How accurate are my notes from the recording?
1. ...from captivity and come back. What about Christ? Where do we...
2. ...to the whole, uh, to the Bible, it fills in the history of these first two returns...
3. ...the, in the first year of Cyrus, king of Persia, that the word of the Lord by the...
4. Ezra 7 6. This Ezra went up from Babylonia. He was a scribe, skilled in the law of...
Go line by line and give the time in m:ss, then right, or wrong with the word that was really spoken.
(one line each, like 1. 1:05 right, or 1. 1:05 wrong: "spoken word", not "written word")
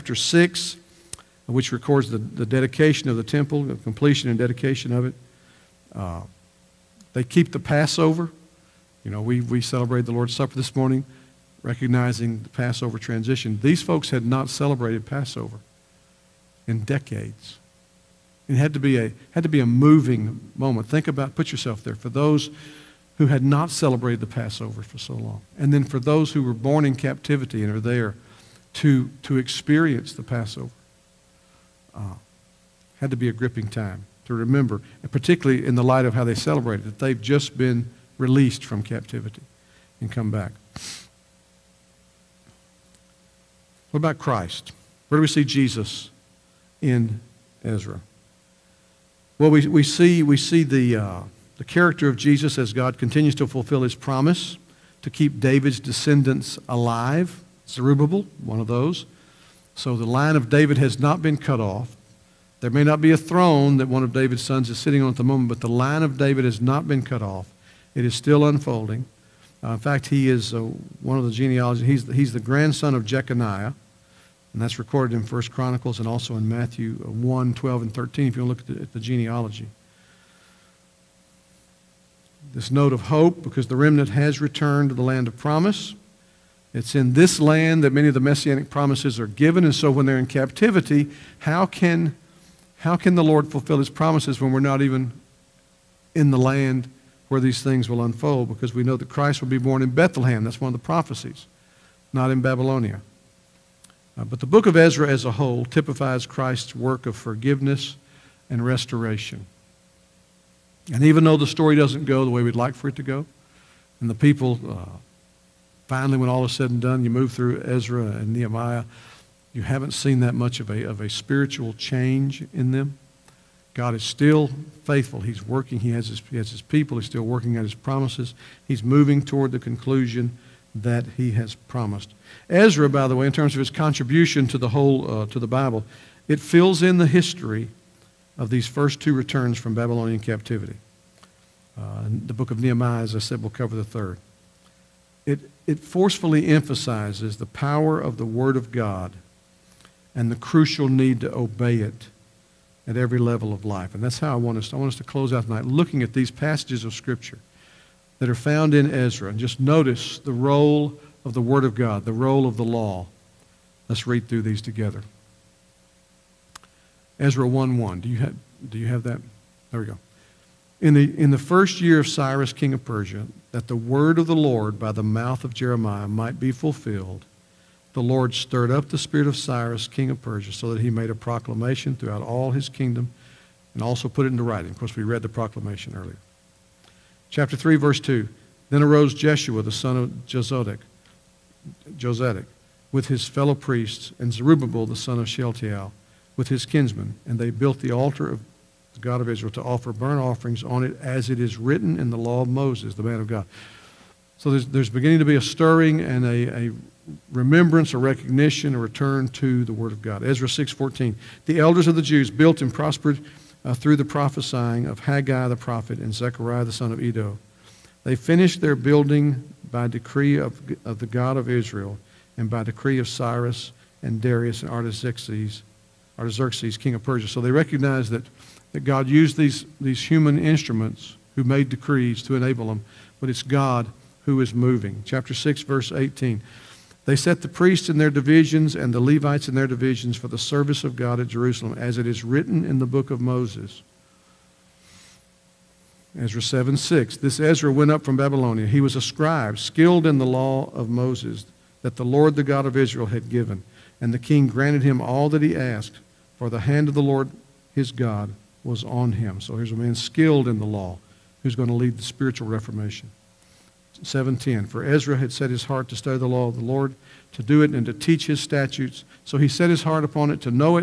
1. 0:38 right
2. 2:14 right
3. 2:50 right
4. 4:06 right.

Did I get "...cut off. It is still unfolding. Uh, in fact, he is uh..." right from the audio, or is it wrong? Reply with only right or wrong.
right.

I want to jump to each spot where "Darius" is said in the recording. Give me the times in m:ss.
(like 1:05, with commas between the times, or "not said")
3:44.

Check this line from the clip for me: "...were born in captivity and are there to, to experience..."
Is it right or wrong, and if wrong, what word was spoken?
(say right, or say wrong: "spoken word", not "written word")
right.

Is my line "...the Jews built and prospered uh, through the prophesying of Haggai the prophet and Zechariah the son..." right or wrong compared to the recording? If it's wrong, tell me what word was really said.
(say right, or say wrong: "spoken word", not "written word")
right.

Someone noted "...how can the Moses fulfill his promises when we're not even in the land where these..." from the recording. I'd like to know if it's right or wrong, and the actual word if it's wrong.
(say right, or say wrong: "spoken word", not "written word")
wrong: "Lord", not "Moses".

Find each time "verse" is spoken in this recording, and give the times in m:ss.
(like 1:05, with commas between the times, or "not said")
3:07, 3:55.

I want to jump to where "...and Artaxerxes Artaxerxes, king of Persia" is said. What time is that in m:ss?
3:44.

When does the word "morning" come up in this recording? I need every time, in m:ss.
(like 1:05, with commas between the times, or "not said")
0:10.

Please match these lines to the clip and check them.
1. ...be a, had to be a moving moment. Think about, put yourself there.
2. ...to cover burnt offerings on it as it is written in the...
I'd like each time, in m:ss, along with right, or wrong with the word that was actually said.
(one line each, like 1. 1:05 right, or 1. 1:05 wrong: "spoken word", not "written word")
1. 0:18 right
2. 3:19 wrong: "offer", not "cover".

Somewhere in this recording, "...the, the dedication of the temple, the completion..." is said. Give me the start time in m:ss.
0:02.